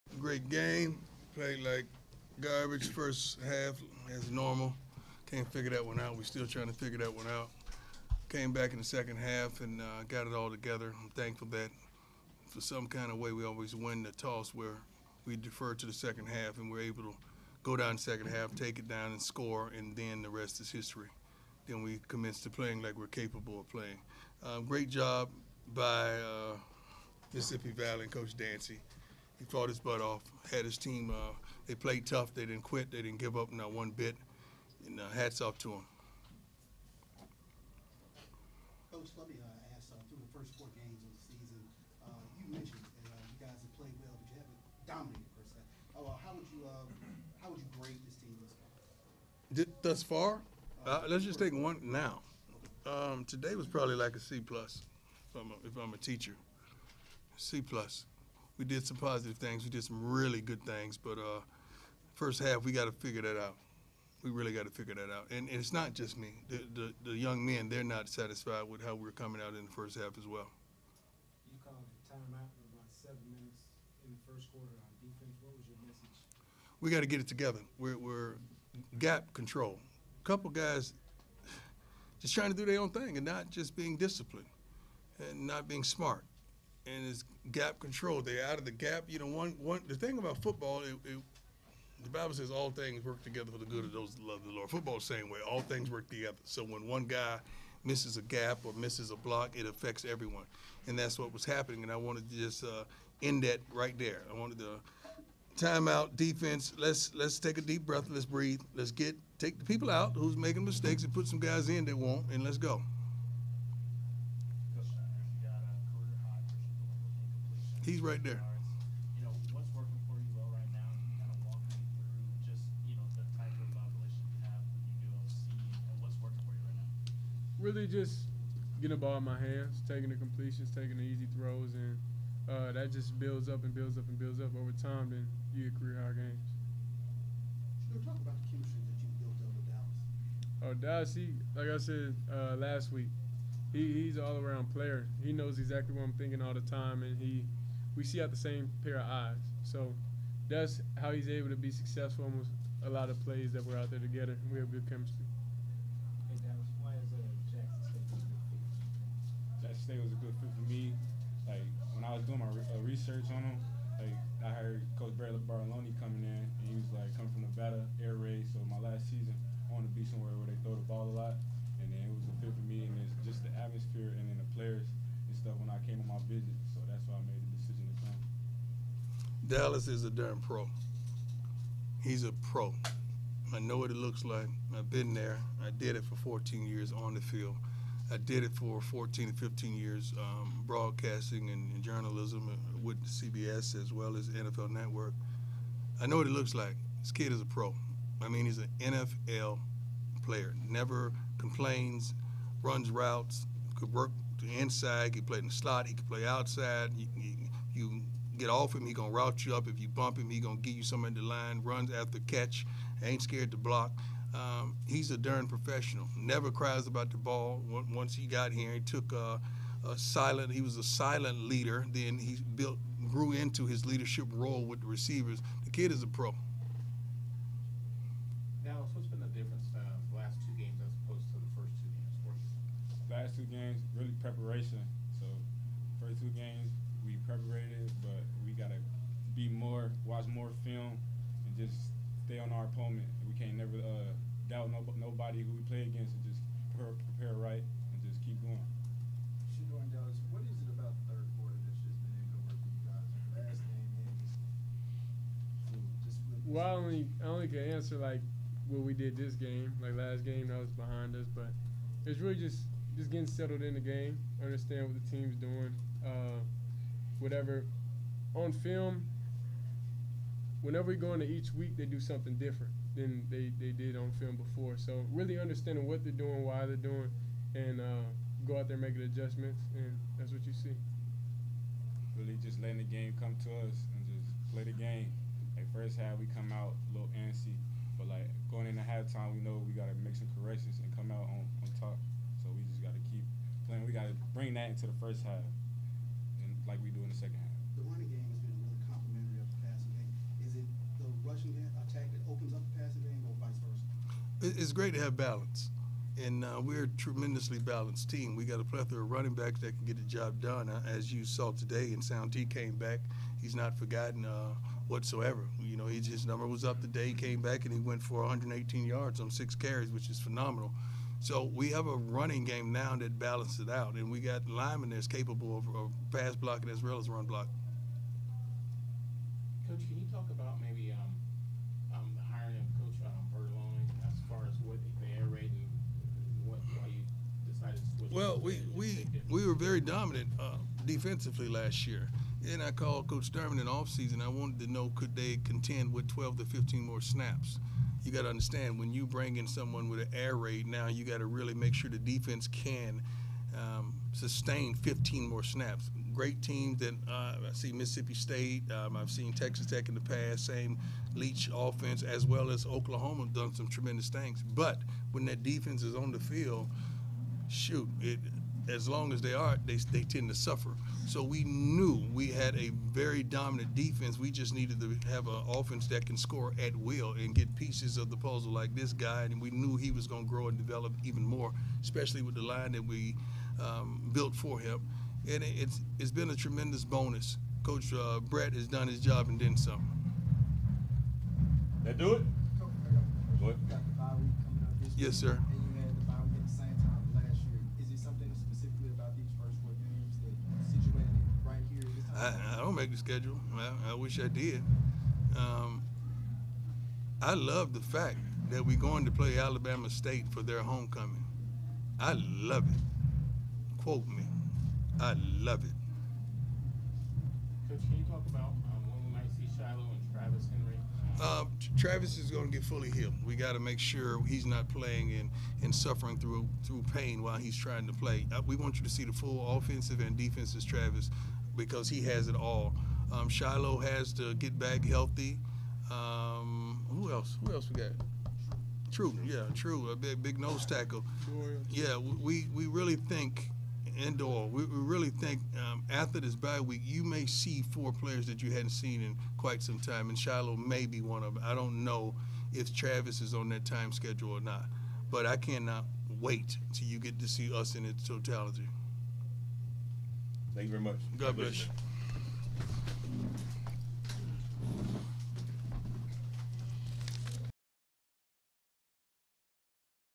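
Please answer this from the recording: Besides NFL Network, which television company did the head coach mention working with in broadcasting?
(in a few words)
CBS.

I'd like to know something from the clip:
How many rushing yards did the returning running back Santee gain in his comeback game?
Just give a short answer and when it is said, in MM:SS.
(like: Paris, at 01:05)
118, at 05:18.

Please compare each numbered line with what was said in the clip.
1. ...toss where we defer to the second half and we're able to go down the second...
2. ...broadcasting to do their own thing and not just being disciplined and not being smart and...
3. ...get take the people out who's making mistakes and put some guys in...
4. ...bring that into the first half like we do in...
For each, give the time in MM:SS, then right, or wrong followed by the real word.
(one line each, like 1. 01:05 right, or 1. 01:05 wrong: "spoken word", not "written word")
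1. 00:14 right
2. 01:22 wrong: "trying", not "broadcasting"
3. 01:48 right
4. 04:54 right.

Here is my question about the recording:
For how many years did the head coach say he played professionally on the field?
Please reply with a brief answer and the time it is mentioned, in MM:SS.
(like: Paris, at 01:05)
14, at 03:06.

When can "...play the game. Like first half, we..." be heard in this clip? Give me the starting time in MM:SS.
04:44.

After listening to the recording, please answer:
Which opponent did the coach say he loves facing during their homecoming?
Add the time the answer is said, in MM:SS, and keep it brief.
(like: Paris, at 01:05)
Alabama State, at 06:49.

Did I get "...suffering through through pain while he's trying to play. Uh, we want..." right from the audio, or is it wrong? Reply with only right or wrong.
right.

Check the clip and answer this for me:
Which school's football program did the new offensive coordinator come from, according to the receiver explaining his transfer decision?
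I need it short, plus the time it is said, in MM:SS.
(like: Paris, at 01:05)
Nevada, at 02:47.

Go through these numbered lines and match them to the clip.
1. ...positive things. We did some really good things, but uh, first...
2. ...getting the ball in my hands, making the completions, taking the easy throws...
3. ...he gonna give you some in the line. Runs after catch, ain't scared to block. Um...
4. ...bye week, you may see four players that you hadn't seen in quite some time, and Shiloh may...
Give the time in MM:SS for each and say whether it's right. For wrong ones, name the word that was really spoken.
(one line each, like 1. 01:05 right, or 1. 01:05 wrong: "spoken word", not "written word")
1. 00:58 right
2. 02:08 wrong: "taking", not "making"
3. 03:30 right
4. 07:26 right.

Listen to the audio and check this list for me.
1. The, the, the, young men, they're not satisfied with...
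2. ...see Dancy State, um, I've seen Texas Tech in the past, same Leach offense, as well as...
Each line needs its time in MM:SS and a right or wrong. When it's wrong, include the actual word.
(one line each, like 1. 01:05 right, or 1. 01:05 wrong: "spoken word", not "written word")
1. 01:06 right
2. 05:57 wrong: "Mississippi", not "Dancy".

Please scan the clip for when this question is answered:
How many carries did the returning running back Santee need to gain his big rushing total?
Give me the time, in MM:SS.
05:19.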